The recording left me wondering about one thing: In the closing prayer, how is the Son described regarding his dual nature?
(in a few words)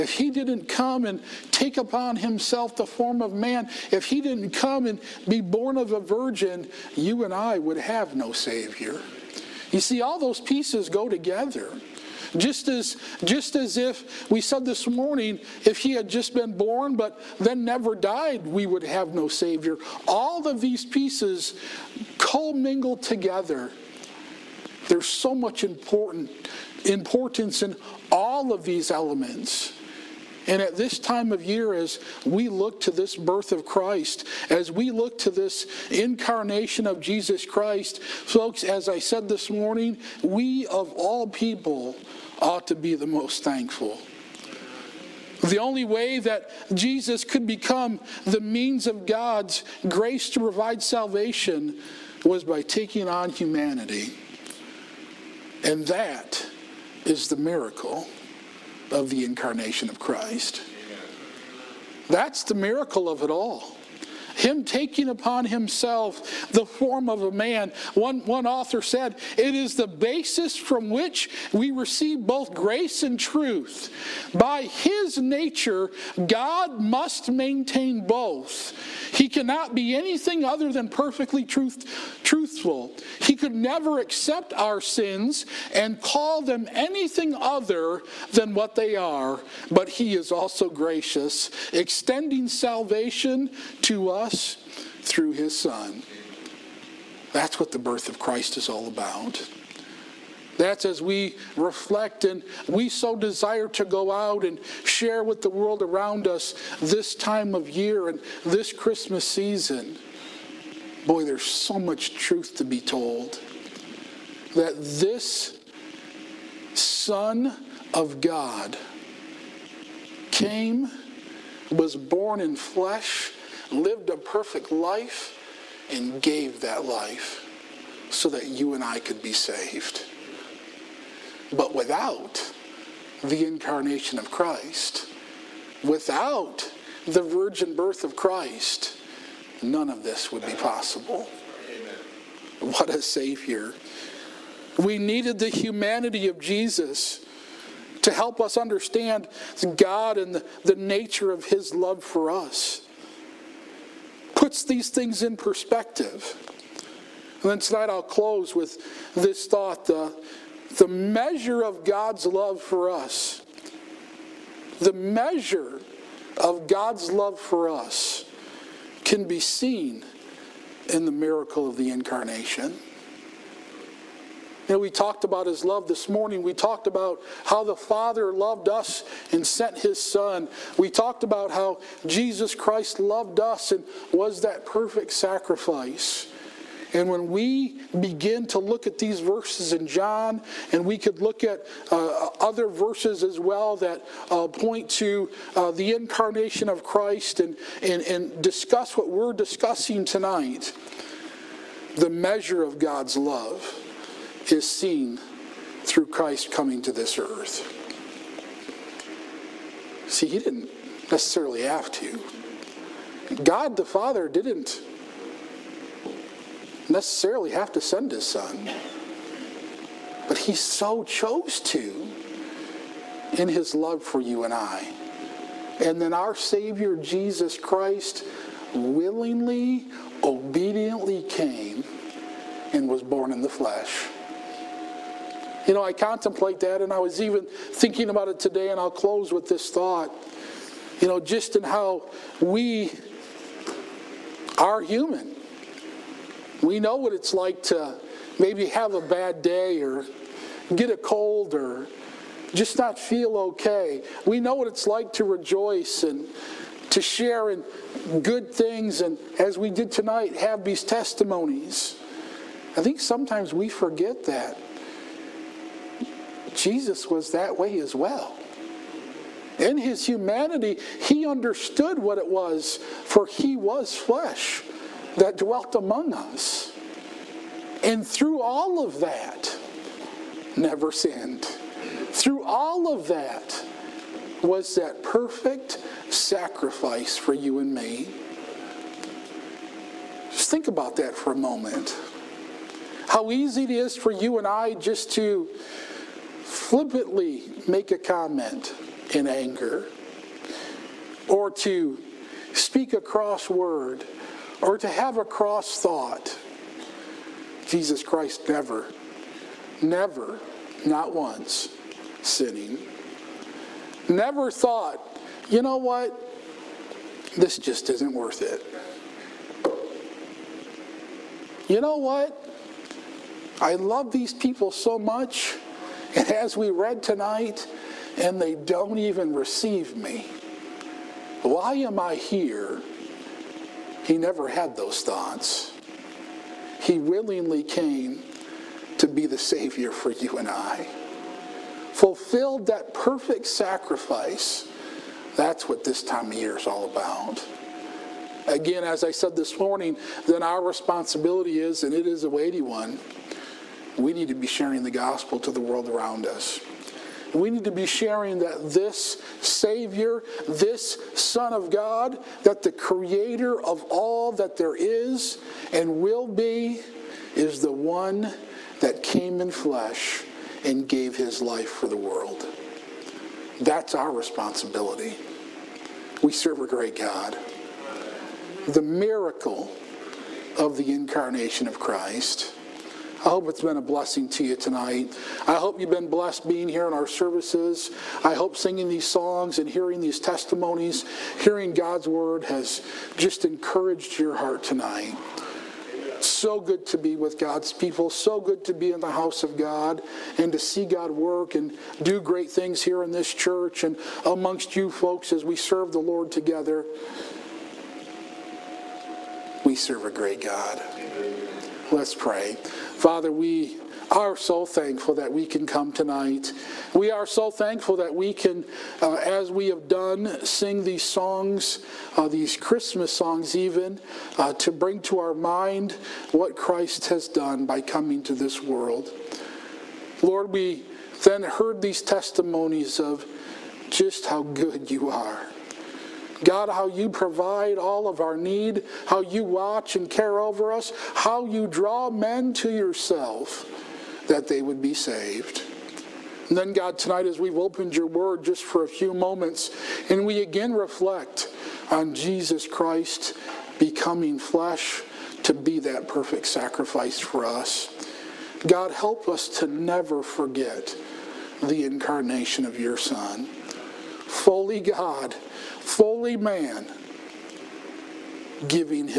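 Fully God, fully man.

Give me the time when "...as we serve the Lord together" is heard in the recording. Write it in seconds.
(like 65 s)
405 s.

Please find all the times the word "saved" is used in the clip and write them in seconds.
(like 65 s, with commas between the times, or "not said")
129 s, 444 s.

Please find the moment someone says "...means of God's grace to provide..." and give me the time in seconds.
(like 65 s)
48 s.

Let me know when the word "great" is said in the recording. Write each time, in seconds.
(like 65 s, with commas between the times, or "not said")
376 s, 402 s, 410 s.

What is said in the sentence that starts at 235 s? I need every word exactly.
You know, I contemplate that, and I was even thinking about it today, and I'll close with this thought.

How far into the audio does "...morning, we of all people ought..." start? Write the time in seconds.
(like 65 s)
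39 s.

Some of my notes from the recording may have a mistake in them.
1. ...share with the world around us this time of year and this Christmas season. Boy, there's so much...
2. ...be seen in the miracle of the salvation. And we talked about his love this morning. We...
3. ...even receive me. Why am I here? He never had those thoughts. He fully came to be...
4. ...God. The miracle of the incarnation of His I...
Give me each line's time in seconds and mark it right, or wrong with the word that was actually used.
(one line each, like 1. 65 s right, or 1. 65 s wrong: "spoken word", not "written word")
1. 104 s right
2. 169 s wrong: "incarnation", not "salvation"
3. 328 s wrong: "willingly", not "fully"
4. 376 s wrong: "Christ", not "His".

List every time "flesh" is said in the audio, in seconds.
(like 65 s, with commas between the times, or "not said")
122 s, 233 s, 273 s, 369 s, 454 s.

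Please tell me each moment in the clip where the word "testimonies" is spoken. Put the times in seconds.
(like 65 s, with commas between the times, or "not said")
260 s, 390 s, 432 s.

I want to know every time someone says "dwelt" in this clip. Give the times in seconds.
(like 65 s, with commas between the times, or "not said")
275 s.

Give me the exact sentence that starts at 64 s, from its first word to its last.
Him taking upon himself the form of a man.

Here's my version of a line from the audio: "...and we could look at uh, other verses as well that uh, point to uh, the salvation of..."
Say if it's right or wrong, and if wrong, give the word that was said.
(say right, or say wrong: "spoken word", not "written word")
wrong: "incarnation", not "salvation".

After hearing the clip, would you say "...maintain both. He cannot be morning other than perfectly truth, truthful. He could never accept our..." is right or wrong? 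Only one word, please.
wrong.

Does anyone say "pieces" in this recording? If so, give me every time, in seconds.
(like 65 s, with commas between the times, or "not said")
10 s, 20 s.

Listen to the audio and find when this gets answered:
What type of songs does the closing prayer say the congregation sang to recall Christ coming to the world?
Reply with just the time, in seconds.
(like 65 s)
422 s.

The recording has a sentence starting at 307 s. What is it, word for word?
Jesus Christ never, never, not once, sinning.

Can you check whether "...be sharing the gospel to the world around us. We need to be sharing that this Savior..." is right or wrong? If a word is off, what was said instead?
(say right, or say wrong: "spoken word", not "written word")
right.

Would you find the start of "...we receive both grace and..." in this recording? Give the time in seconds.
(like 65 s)
71 s.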